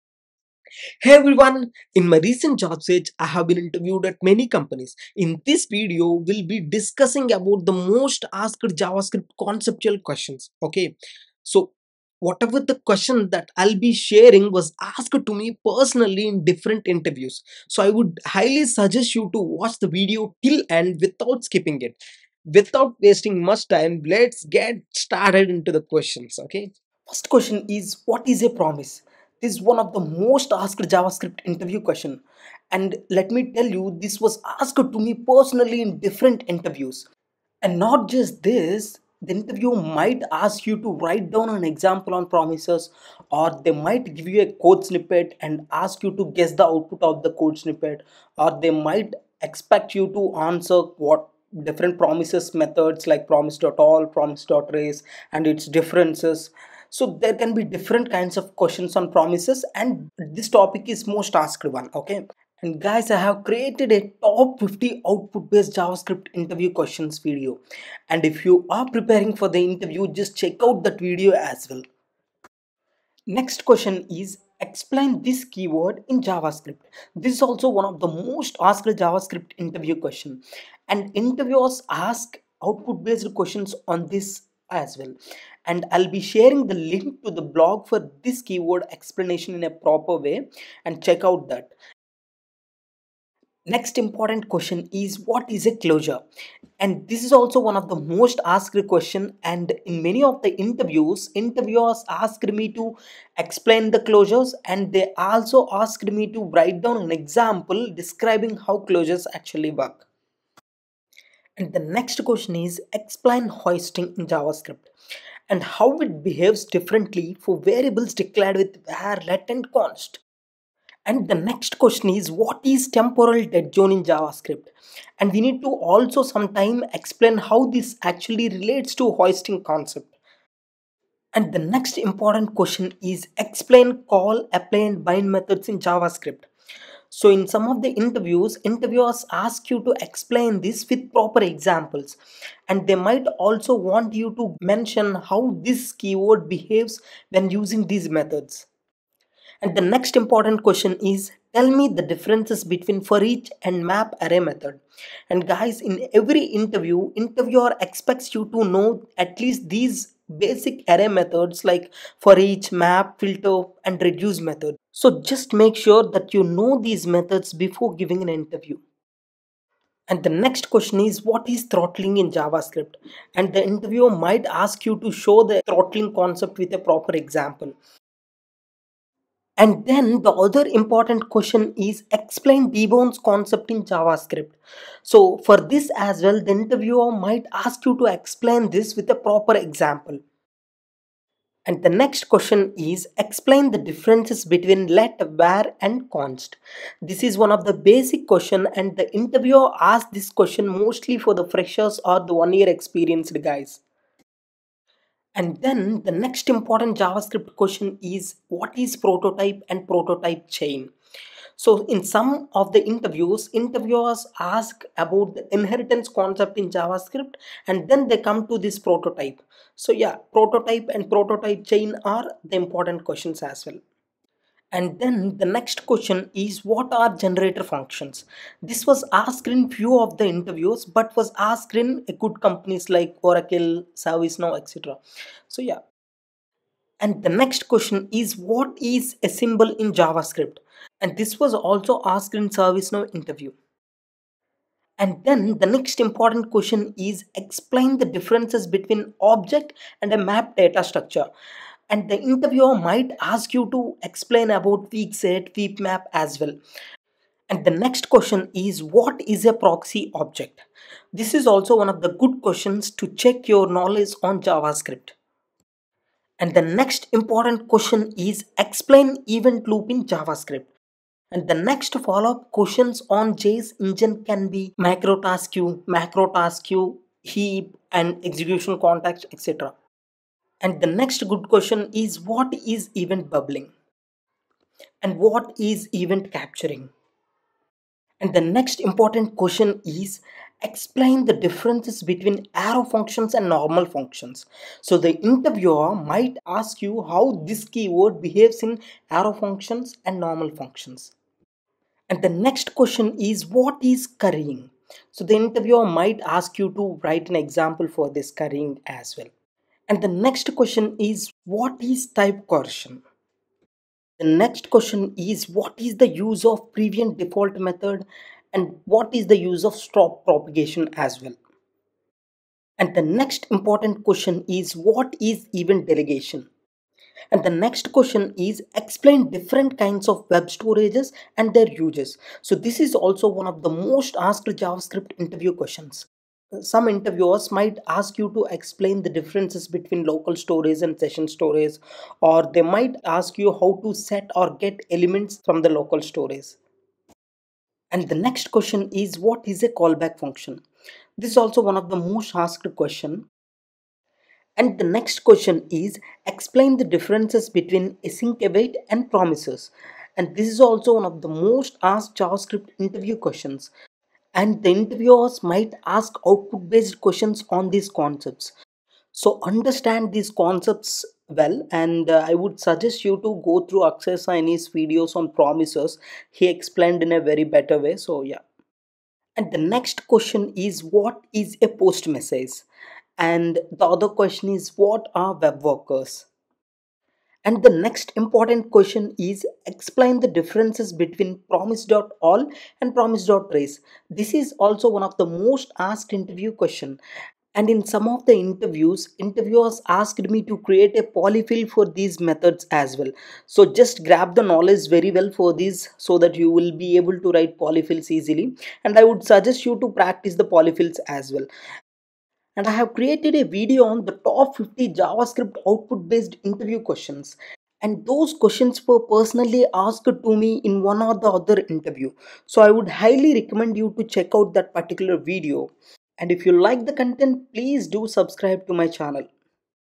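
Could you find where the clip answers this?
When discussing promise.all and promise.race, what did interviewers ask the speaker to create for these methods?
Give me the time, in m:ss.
6:41.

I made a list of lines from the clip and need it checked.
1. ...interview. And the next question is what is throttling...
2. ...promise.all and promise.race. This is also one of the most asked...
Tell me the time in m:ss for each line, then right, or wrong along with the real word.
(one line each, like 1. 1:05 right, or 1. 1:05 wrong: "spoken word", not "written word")
1. 2:48 right
2. 6:31 right.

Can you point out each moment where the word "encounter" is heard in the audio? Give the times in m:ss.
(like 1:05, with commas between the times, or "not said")
not said.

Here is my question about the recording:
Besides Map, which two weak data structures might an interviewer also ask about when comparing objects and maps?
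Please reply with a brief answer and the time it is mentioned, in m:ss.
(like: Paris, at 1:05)
weak set, weak map, at 4:14.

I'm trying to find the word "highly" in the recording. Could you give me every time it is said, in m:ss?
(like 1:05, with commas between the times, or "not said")
0:18, 7:02.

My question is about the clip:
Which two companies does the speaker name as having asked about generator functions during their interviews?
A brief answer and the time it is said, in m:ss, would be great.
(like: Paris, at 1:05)
Oracle, ServiceNow, at 3:53.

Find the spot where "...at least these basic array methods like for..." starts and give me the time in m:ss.
2:39.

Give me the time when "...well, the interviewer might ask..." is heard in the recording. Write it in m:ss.
3:06.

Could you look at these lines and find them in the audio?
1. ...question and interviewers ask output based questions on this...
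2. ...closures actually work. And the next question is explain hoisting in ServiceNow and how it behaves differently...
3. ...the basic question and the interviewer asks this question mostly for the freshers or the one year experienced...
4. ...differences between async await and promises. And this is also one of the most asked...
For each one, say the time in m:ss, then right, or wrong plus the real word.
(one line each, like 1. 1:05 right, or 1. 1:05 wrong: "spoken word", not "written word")
1. 1:19 right
2. 1:48 wrong: "JavaScript", not "ServiceNow"
3. 3:17 right
4. 5:56 right.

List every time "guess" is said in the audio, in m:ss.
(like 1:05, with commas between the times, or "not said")
0:46.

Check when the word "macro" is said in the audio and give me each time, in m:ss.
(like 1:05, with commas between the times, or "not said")
4:35.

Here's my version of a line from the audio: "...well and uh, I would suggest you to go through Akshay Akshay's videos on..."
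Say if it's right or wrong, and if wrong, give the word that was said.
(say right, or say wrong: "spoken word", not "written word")
wrong: "Saini", not "Akshay".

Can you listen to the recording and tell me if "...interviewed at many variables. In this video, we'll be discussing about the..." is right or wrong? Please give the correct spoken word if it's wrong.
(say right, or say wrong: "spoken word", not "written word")
wrong: "companies", not "variables".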